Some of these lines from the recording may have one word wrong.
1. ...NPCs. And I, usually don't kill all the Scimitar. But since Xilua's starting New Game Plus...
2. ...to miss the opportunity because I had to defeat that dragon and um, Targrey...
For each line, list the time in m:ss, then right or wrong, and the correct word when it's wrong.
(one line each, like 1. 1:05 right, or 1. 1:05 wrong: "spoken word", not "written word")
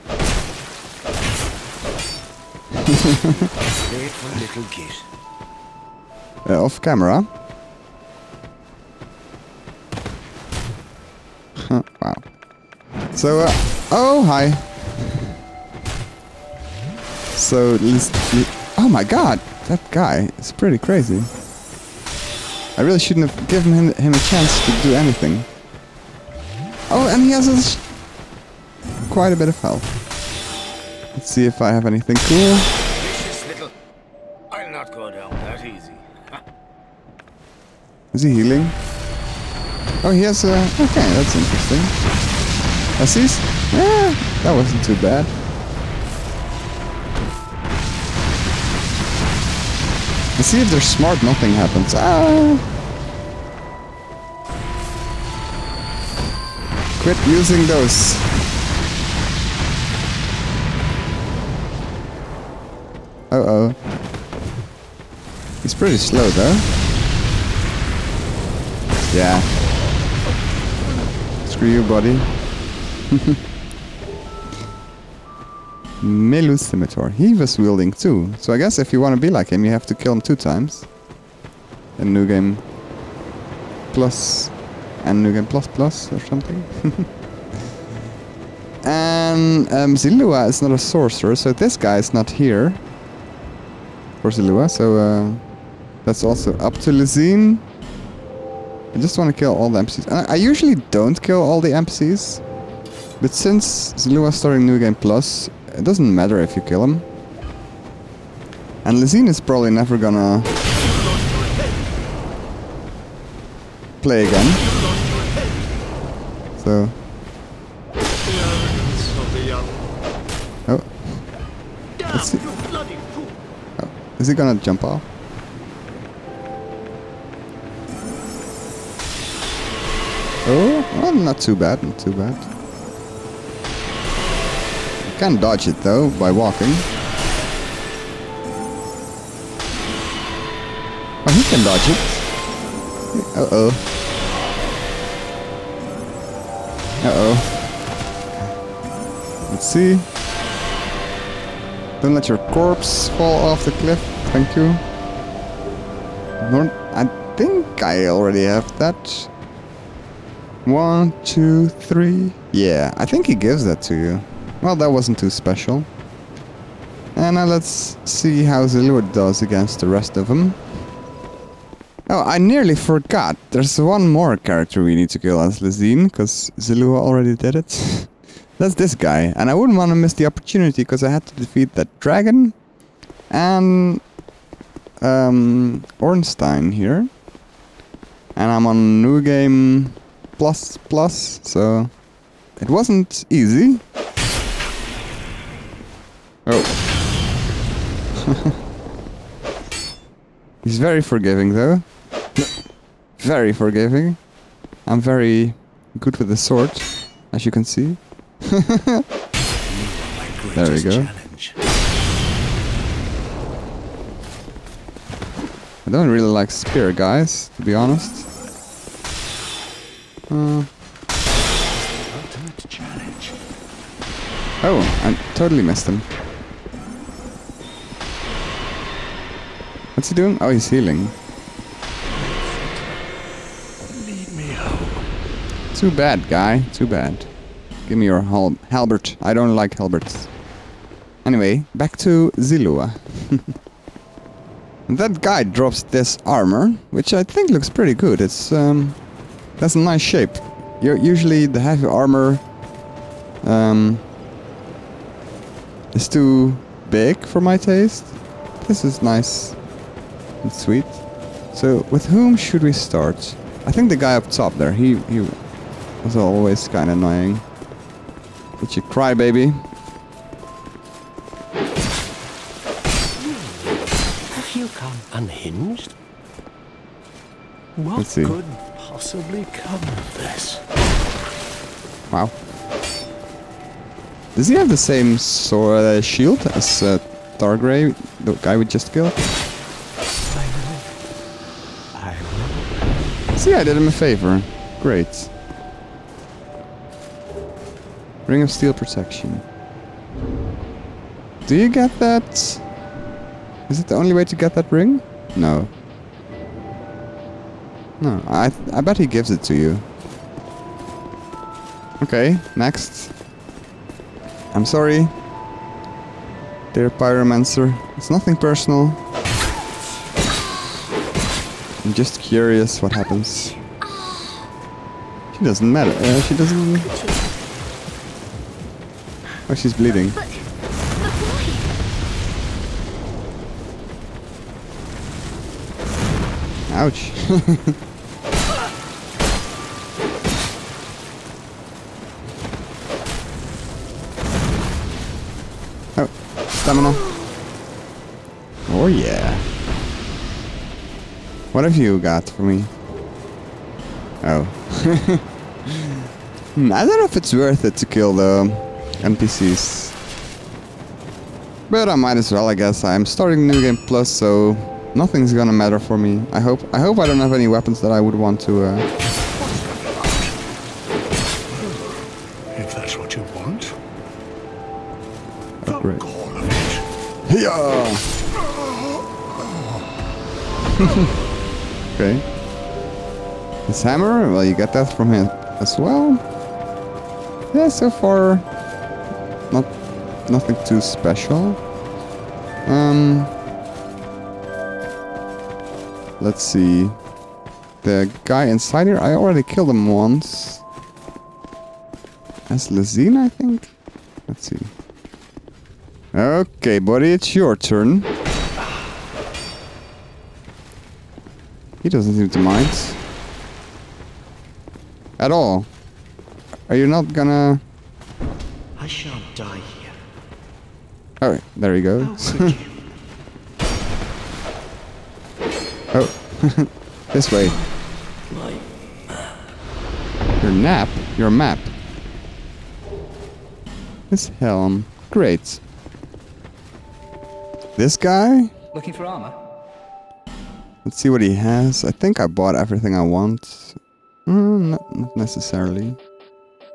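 1. 1:39 wrong: "NPCs", not "Scimitar"
2. 2:59 wrong: "Ornstein", not "Targrey".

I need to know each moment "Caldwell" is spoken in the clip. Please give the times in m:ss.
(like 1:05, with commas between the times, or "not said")
not said.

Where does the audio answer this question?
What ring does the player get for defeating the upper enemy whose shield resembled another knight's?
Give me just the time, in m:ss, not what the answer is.
4:58.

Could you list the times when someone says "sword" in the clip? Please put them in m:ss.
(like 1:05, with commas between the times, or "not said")
3:26, 4:45.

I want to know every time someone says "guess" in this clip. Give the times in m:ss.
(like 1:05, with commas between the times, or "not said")
1:18, 6:02.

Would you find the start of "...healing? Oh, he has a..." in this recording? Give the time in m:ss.
0:38.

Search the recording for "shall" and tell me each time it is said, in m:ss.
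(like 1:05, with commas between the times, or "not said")
6:58.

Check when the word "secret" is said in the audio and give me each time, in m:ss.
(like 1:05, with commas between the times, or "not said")
not said.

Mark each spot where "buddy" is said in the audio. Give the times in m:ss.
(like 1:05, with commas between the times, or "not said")
1:11, 6:46.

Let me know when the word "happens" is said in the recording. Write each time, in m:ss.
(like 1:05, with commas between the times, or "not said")
0:51, 5:22.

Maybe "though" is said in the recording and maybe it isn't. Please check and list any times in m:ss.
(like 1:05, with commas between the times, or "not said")
1:06, 2:15, 3:21.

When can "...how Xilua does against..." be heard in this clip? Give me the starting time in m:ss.
2:48.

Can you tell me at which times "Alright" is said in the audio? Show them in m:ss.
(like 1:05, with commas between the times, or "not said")
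7:01.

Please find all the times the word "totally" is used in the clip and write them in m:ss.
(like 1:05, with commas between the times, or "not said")
3:45.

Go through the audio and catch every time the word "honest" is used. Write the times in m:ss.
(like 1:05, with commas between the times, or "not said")
3:37.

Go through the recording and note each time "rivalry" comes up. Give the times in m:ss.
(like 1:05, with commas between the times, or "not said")
not said.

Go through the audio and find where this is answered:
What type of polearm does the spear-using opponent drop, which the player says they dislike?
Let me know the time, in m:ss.
3:58.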